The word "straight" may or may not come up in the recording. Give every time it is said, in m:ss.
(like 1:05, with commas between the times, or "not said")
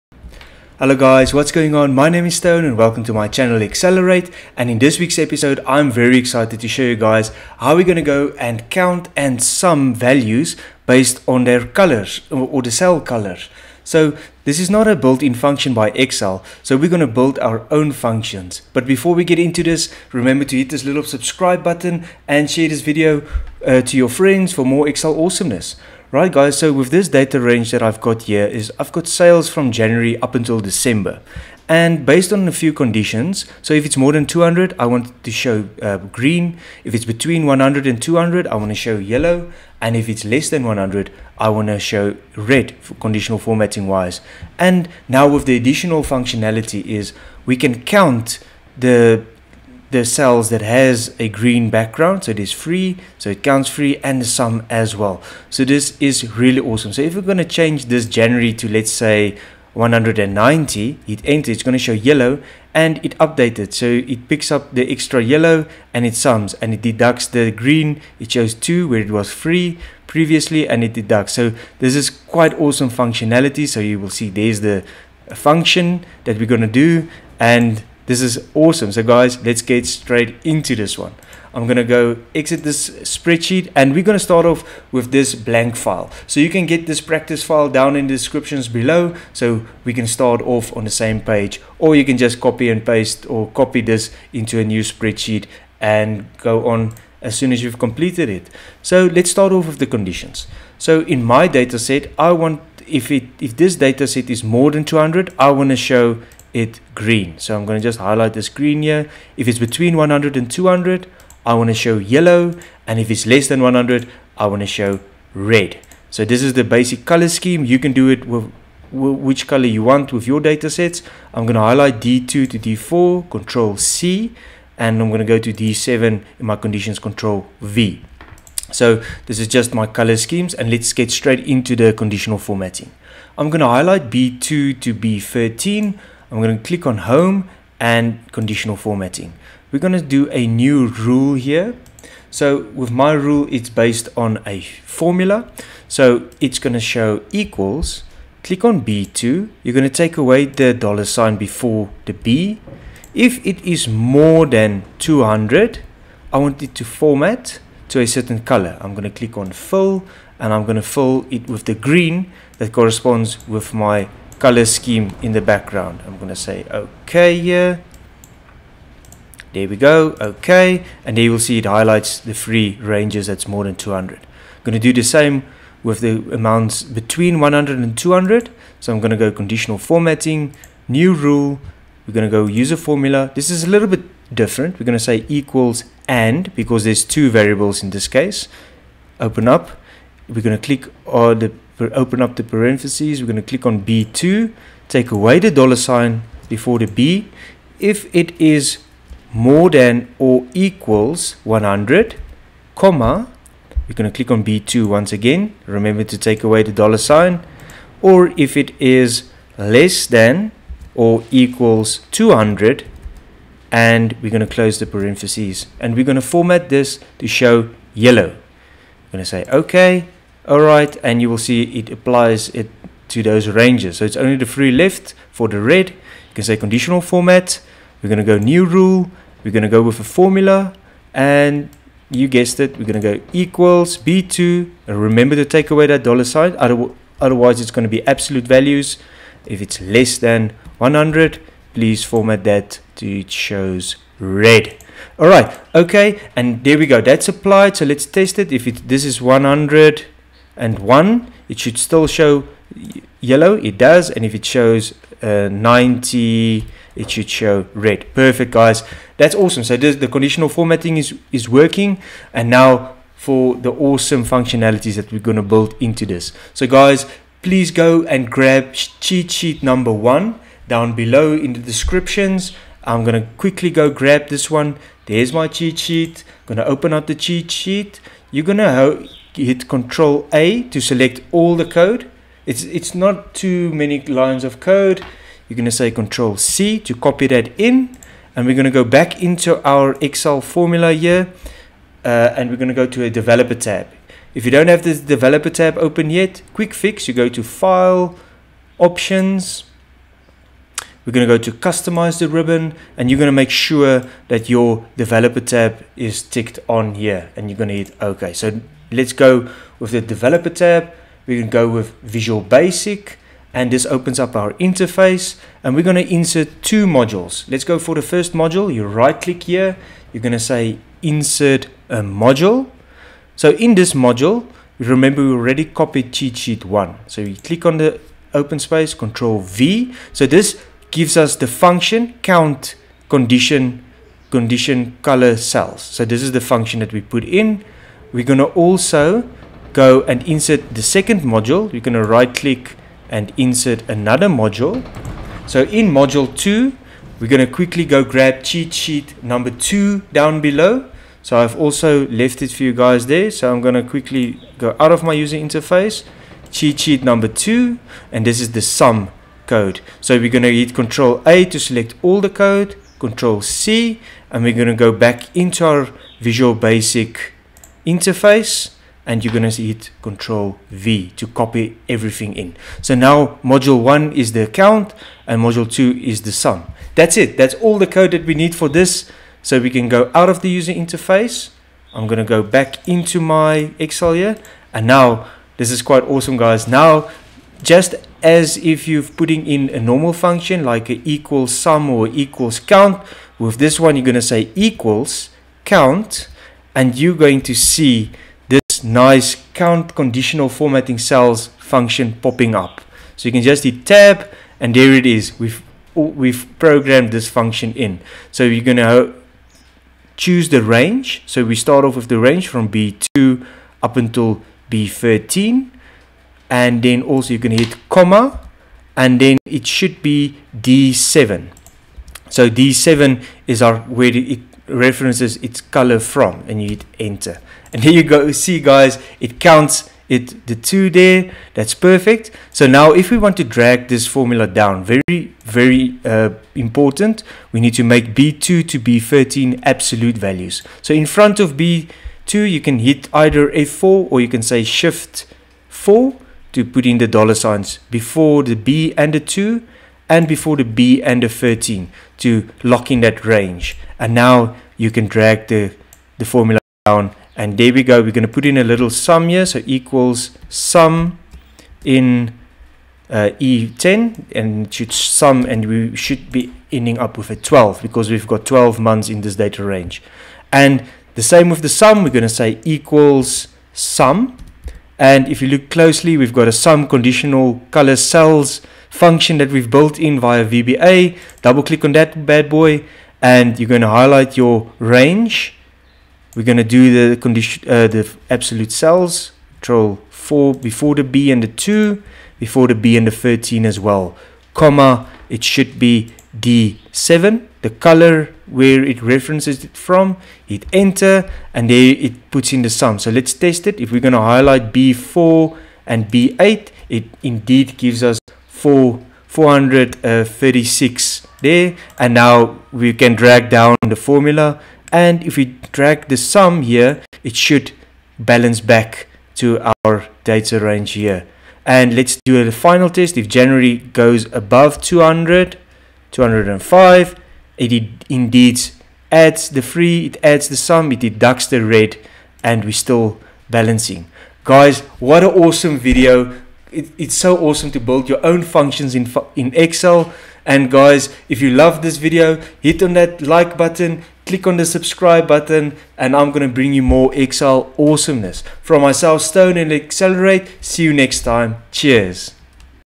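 1:19, 2:11.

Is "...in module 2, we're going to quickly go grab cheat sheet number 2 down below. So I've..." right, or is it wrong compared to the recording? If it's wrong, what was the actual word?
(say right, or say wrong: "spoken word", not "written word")
right.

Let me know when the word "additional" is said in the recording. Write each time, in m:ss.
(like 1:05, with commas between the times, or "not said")
0:45.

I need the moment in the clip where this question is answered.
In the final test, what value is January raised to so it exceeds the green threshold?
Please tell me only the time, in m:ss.
8:46.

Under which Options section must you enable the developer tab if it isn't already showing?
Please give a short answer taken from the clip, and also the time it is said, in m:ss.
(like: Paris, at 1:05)
Customize the ribbon, at 5:01.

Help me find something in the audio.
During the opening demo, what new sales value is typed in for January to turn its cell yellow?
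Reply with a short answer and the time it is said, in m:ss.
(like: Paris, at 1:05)
190, at 0:59.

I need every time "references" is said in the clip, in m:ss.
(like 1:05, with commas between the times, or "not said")
7:04, 8:19.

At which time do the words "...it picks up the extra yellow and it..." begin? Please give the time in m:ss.
1:03.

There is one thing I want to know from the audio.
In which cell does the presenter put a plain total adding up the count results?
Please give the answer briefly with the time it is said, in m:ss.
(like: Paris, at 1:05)
E10, at 7:43.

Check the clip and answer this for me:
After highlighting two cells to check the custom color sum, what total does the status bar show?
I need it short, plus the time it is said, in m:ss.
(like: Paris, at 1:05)
4,436, at 8:28.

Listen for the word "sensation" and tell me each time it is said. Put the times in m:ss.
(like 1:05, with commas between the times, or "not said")
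not said.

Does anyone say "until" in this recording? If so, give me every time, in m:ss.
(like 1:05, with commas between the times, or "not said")
0:30, 6:53.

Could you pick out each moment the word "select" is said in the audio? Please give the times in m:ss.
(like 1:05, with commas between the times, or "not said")
4:40, 6:01.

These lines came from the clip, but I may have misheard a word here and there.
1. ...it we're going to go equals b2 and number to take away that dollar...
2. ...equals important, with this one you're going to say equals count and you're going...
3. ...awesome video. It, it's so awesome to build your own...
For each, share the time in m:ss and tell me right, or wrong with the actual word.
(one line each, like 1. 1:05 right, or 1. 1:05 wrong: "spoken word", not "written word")
1. 3:52 wrong: "remember", not "number"
2. 6:32 wrong: "count", not "important"
3. 8:55 right.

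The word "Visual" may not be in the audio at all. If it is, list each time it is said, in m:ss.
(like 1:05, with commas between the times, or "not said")
5:12, 6:06.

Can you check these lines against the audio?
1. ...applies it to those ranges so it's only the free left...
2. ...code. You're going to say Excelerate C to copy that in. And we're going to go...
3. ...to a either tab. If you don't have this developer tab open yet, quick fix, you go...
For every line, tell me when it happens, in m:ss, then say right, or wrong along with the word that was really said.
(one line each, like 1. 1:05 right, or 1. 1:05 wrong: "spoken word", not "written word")
1. 3:41 right
2. 4:44 wrong: "Control", not "Excelerate"
3. 4:52 wrong: "developer", not "either".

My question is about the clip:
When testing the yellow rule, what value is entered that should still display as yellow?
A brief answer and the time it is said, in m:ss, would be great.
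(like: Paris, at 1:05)
101, at 4:09.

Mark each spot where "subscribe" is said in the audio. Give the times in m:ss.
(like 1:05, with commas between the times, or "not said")
0:21, 9:04.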